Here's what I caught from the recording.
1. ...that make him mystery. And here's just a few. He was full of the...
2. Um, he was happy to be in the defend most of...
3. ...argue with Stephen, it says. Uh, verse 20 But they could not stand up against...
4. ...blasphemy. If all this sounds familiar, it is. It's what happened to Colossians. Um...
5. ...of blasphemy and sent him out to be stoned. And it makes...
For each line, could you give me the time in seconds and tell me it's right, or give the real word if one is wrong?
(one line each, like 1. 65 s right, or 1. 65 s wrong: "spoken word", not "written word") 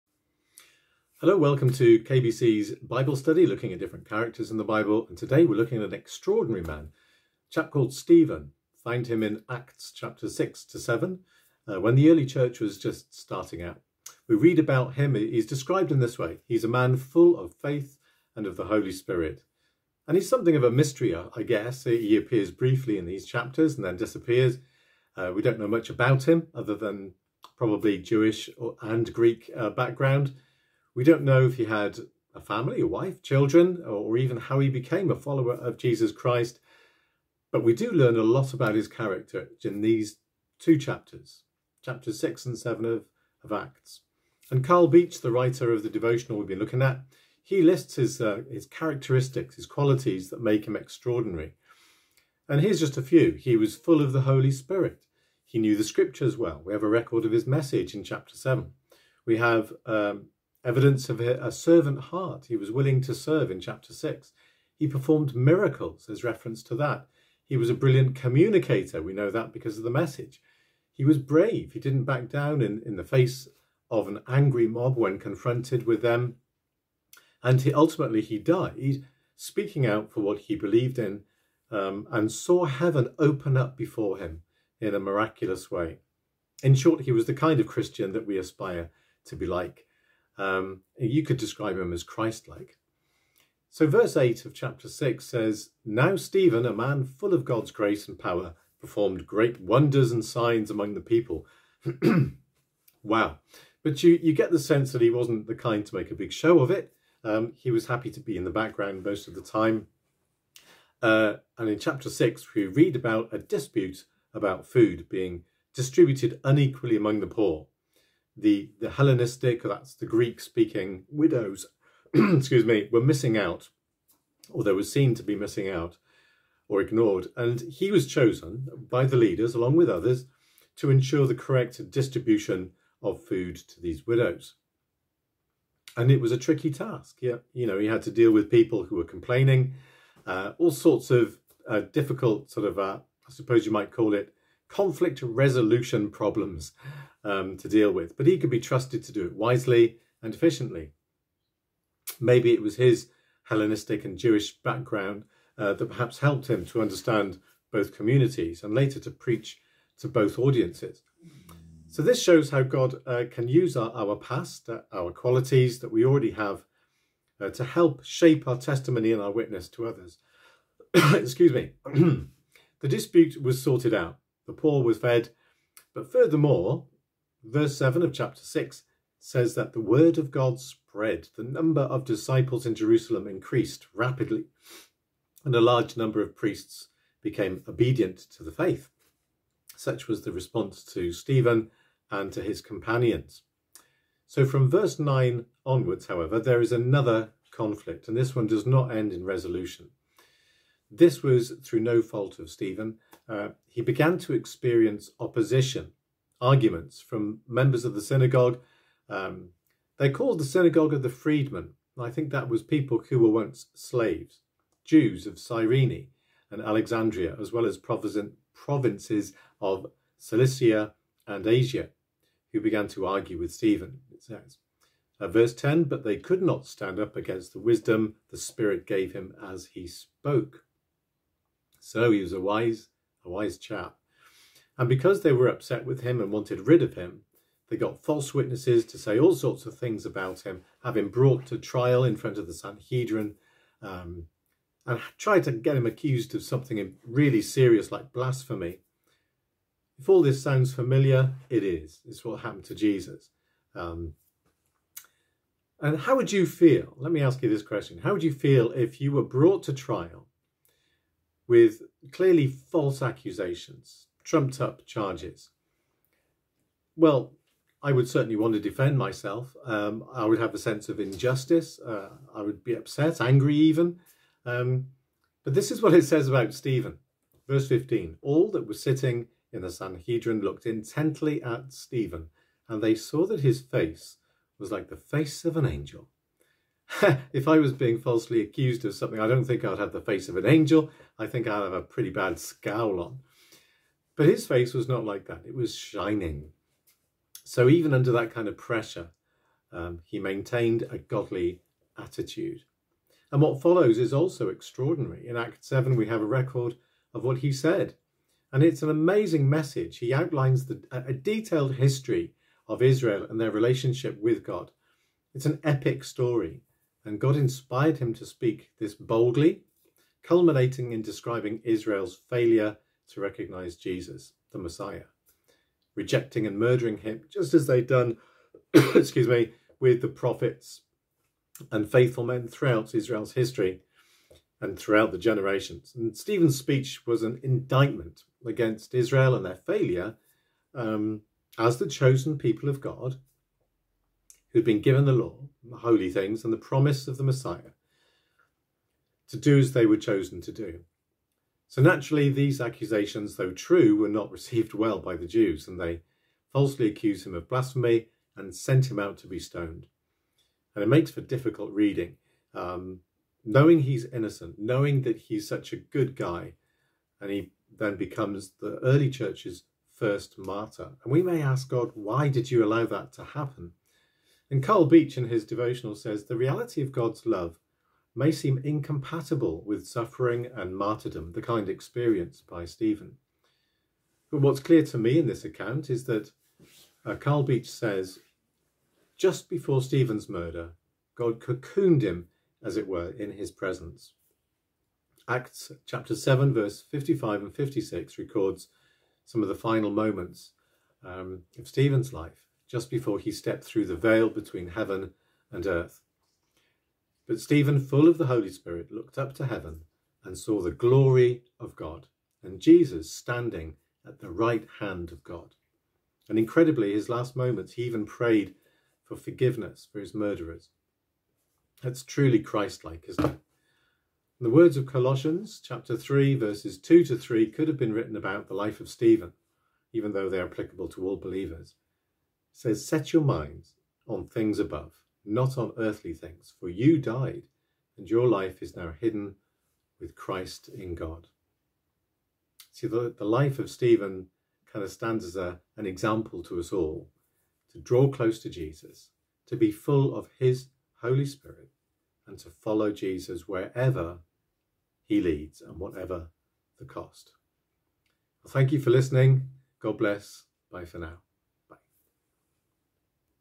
1. 50 s wrong: "extraordinary", not "mystery"
2. 107 s wrong: "background", not "defend"
3. 223 s wrong: "10", not "20"
4. 248 s wrong: "Jesus", not "Colossians"
5. 357 s right.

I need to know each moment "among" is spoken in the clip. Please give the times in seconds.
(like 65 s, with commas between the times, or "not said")
100 s, 116 s.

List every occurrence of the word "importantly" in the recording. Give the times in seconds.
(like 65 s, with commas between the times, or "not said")
not said.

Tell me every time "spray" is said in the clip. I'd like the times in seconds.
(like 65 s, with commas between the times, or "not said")
not said.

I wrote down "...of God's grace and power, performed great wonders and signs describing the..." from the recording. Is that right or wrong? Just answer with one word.
wrong.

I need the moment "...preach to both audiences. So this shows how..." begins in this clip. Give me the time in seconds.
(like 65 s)
159 s.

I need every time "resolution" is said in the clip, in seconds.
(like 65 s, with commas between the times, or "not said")
145 s, 199 s.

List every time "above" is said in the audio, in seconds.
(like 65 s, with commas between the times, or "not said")
434 s.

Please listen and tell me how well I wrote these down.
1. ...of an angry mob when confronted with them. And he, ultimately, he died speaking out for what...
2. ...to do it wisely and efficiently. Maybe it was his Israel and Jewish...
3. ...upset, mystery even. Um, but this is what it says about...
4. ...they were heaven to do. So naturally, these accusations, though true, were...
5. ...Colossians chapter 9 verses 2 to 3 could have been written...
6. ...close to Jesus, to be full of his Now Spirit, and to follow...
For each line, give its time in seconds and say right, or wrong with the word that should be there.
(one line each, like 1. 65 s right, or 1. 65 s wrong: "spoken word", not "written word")
1. 73 s right
2. 149 s wrong: "Hellenistic", not "Israel"
3. 272 s wrong: "angry", not "mystery"
4. 349 s wrong: "chosen", not "heaven"
5. 424 s wrong: "3", not "9"
6. 448 s wrong: "Holy", not "Now".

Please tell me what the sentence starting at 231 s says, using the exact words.
So he was a wise, a wise chap.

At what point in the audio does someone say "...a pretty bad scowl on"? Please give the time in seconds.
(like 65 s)
291 s.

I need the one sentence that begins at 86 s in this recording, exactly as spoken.
In short, he was the kind of Christian that we aspire to be like.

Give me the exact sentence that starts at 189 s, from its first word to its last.
Such was the response to Stephen and to his companions.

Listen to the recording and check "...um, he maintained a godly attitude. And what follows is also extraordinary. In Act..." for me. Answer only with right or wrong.
right.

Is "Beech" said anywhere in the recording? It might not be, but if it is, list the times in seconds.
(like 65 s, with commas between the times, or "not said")
44 s, 374 s, 387 s.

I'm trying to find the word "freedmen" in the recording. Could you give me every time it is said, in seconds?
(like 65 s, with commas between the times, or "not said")
211 s.